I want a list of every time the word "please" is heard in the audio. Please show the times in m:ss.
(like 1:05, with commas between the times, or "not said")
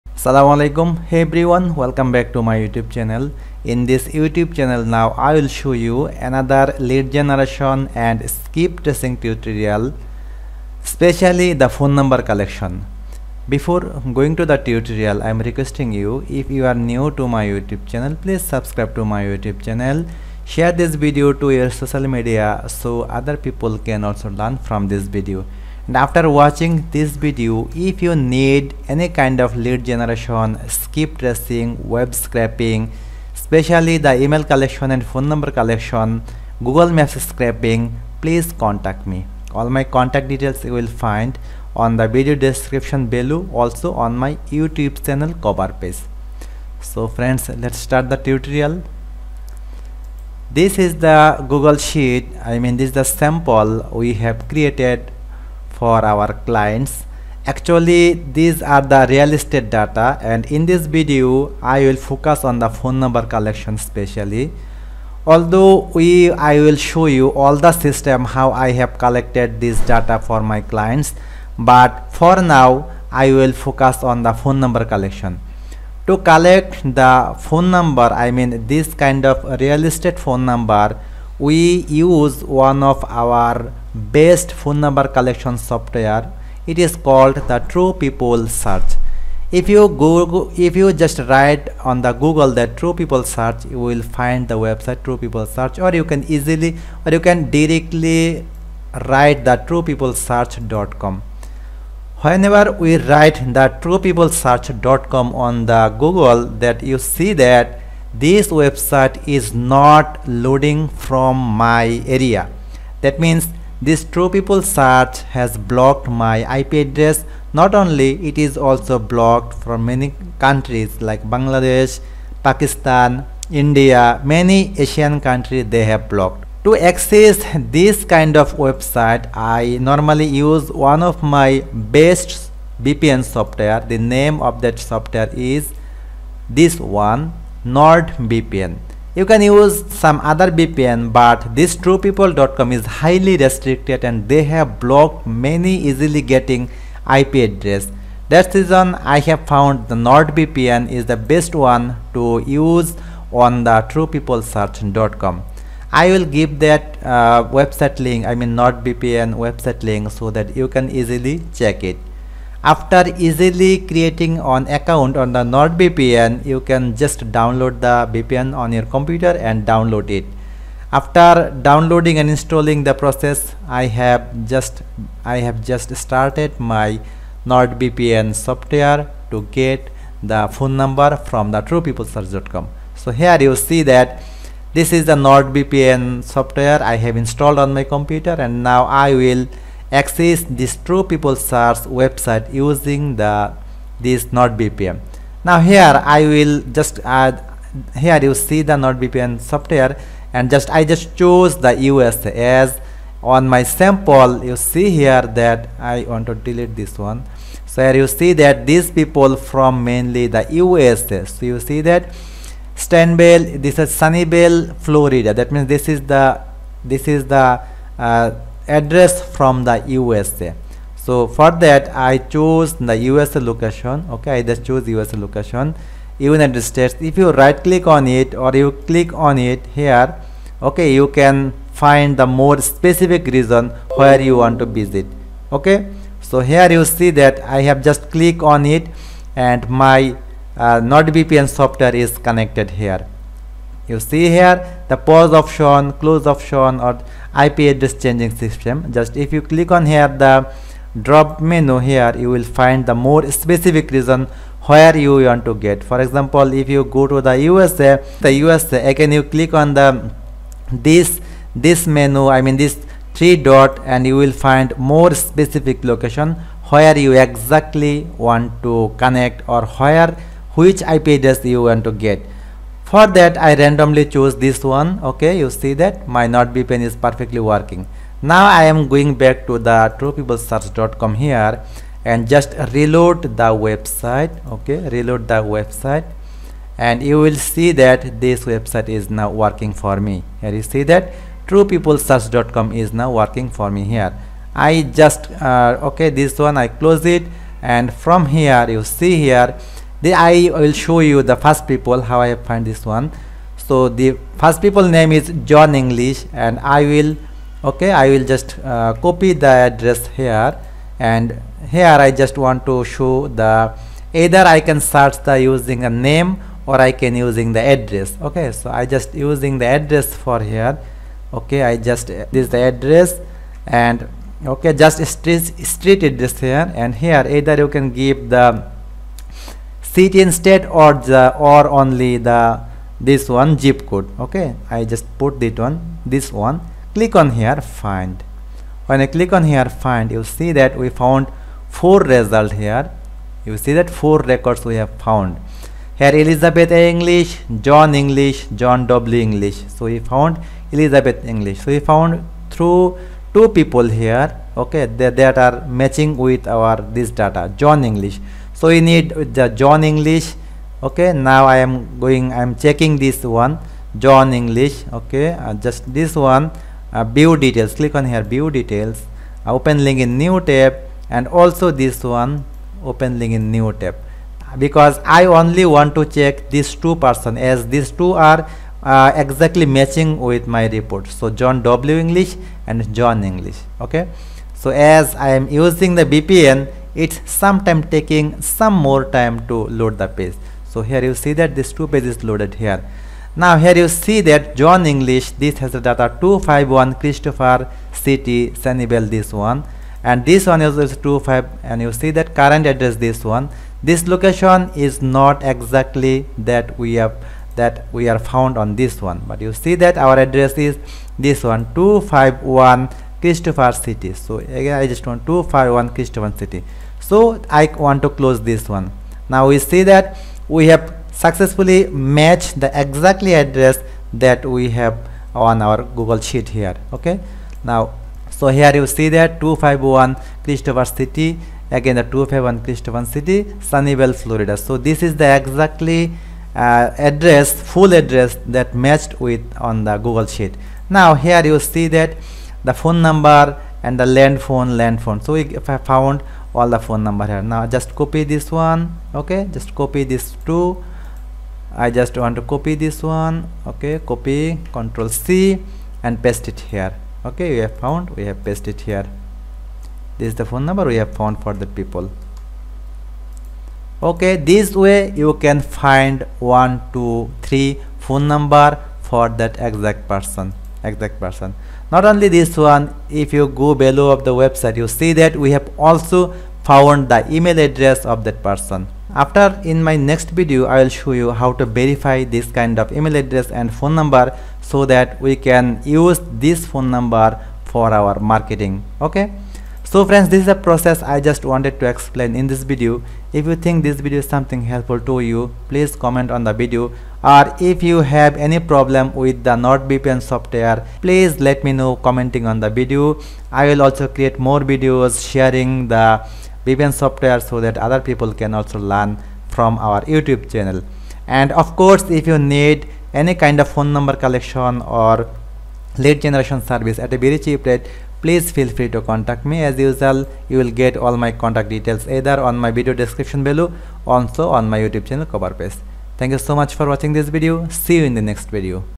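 0:18, 0:38, 8:15, 8:21, 8:38.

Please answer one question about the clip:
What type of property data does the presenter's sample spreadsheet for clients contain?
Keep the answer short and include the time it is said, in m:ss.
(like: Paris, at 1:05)
real estate data, at 0:59.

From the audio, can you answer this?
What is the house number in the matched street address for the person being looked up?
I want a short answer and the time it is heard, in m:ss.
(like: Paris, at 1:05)
251, at 6:36.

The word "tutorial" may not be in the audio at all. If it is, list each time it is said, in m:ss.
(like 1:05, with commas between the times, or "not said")
0:09, 0:14, 0:48.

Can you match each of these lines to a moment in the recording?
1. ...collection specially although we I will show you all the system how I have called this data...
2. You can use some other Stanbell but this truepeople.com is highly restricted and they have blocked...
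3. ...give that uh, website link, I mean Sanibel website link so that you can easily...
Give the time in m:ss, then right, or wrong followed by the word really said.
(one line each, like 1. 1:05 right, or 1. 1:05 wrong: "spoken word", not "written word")
1. 1:03 wrong: "collected", not "called"
2. 2:19 wrong: "VPN", not "Stanbell"
3. 2:36 wrong: "NordVPN", not "Sanibel".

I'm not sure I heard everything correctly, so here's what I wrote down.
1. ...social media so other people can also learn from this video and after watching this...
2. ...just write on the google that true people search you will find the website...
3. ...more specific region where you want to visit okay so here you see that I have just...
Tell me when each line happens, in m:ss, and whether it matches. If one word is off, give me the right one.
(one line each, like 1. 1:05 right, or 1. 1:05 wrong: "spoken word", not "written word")
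1. 0:21 right
2. 1:30 right
3. 3:52 right.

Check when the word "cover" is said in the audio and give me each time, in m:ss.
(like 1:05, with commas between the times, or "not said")
0:45, 8:45.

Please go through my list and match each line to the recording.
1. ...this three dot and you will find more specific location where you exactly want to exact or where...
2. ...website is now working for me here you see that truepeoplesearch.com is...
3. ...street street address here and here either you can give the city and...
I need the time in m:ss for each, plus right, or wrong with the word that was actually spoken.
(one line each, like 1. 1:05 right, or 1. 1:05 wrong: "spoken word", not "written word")
1. 4:22 wrong: "connect", not "exact"
2. 4:48 right
3. 5:25 right.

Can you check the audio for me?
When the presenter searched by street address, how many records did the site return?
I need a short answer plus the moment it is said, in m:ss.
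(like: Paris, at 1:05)
4, at 5:43.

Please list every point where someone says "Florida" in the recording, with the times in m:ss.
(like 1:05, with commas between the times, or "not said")
3:34, 7:14.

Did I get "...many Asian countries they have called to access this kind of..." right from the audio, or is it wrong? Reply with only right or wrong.
wrong.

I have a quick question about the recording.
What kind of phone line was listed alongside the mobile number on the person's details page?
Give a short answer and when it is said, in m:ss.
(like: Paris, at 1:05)
land phone, at 7:24.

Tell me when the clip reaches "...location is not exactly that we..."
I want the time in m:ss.
6:44.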